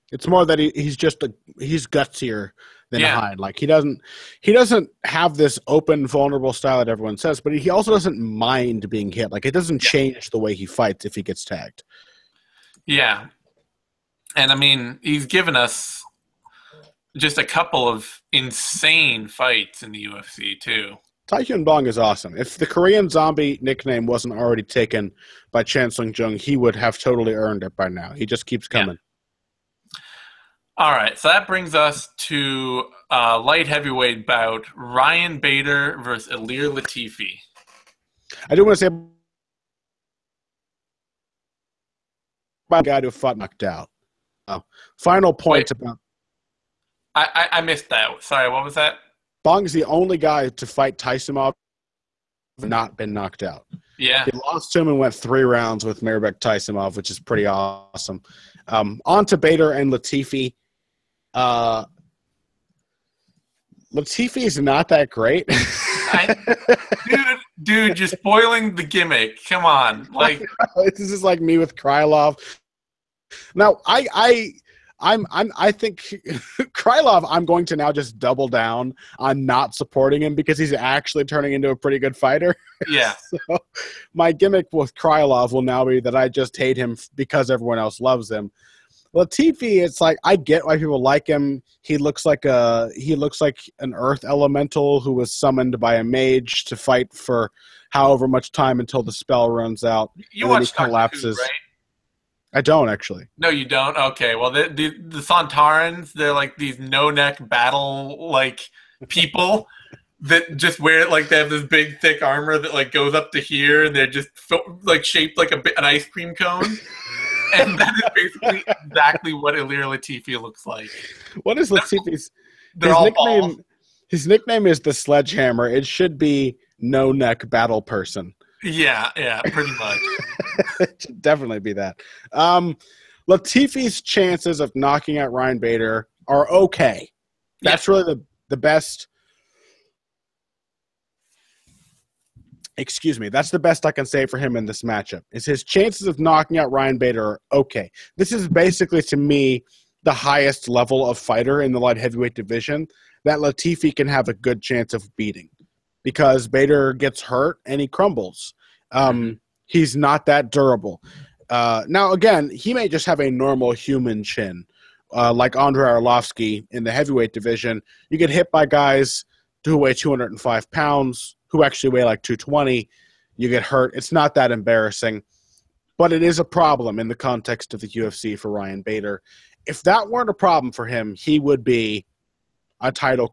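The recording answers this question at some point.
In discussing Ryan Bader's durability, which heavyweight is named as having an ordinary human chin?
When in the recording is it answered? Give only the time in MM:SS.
02:45.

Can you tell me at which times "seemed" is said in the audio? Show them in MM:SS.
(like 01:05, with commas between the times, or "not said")
not said.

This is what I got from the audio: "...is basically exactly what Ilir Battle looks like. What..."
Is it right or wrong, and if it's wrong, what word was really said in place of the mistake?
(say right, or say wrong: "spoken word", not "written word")
wrong: "Latifi", not "Battle".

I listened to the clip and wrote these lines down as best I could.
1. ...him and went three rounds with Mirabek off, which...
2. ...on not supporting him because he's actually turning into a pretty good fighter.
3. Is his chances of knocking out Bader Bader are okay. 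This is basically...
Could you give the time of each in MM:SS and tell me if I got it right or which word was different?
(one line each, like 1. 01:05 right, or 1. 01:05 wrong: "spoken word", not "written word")
1. 00:54 right
2. 01:19 right
3. 02:25 wrong: "Ryan", not "Bader".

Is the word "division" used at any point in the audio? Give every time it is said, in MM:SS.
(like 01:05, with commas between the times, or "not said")
02:32, 02:47.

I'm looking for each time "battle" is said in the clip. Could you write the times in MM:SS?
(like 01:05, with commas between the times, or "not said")
01:47, 02:07.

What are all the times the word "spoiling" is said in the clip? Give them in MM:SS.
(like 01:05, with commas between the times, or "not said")
01:08.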